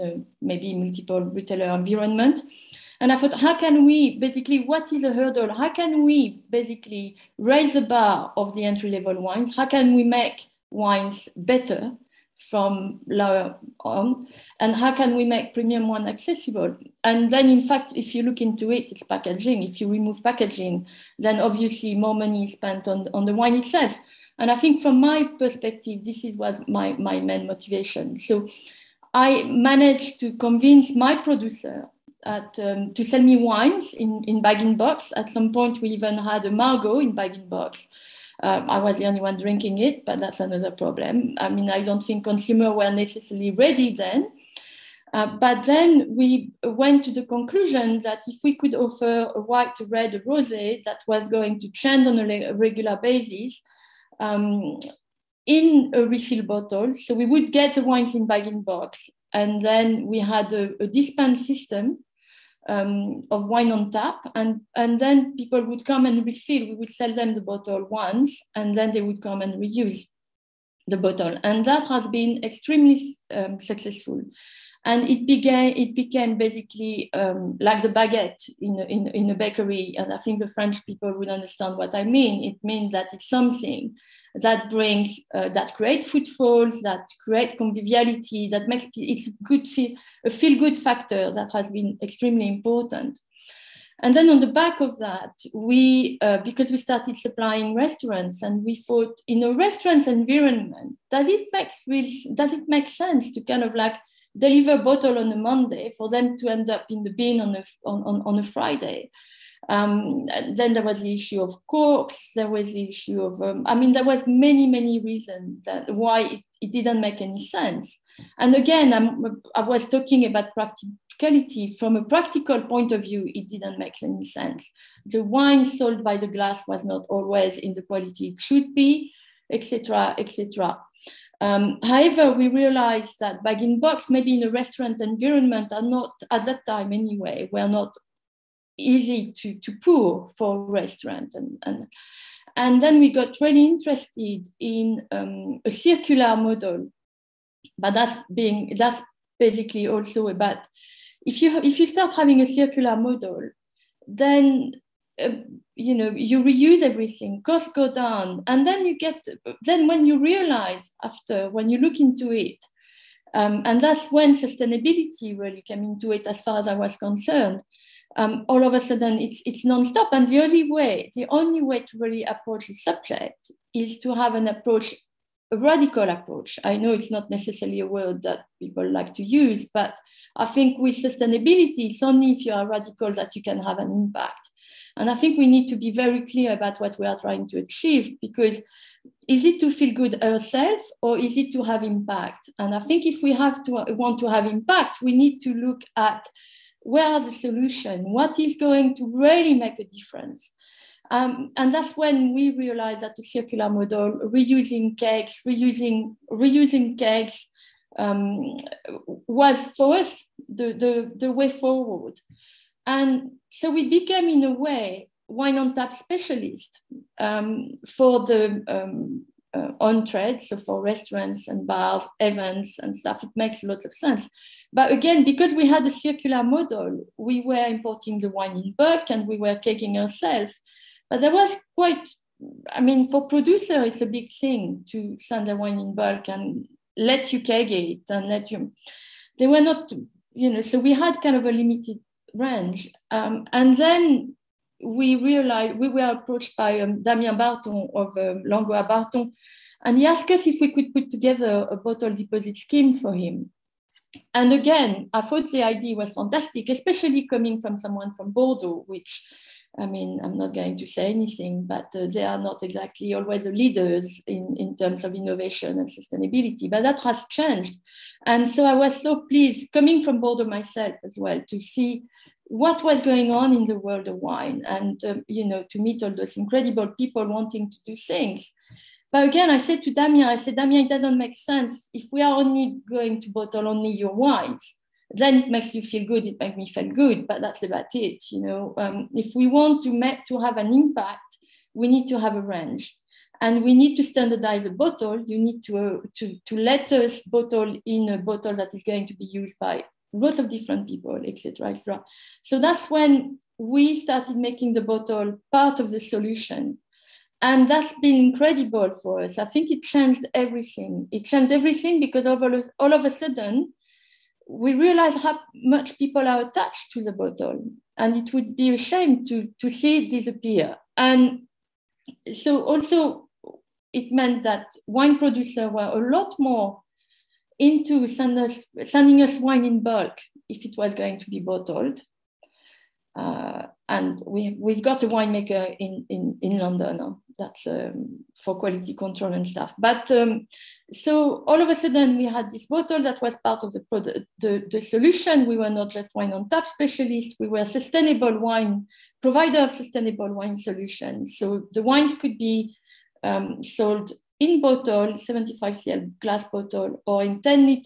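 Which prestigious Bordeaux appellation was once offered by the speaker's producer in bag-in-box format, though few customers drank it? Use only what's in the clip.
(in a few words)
Margaux.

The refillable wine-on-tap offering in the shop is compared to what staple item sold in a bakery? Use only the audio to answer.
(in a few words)
baguette.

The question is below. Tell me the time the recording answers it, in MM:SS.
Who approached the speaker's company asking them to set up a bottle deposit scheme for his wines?
04:07.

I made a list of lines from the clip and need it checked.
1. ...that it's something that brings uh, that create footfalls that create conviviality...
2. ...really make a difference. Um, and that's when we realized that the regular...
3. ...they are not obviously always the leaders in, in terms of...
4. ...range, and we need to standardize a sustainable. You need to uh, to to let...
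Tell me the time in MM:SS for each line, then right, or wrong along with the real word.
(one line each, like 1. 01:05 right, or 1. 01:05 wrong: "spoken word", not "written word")
1. 01:22 right
2. 03:19 wrong: "circular", not "regular"
3. 04:22 wrong: "exactly", not "obviously"
4. 04:52 wrong: "bottle", not "sustainable".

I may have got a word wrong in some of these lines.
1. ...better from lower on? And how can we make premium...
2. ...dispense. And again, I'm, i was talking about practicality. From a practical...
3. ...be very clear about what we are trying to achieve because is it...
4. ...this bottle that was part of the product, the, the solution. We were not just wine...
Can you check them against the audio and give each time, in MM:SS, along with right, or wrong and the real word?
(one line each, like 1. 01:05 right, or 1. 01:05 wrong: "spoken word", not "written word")
1. 00:11 right
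2. 01:57 wrong: "sense", not "dispense"
3. 03:05 right
4. 05:42 right.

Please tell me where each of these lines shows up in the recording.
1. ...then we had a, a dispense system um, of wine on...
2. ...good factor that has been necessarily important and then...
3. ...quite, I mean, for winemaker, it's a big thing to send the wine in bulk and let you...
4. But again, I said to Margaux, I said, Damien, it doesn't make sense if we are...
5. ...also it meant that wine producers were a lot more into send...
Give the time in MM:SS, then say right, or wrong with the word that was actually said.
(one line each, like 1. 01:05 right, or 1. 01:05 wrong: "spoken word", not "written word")
1. 00:59 right
2. 01:30 wrong: "extremely", not "necessarily"
3. 03:51 wrong: "producer", not "winemaker"
4. 04:39 wrong: "Damien", not "Margaux"
5. 05:22 right.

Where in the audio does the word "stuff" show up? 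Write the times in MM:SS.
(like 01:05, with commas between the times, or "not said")
03:42, 05:39.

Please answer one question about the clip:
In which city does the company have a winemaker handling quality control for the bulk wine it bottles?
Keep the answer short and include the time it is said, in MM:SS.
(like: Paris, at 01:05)
London, at 05:36.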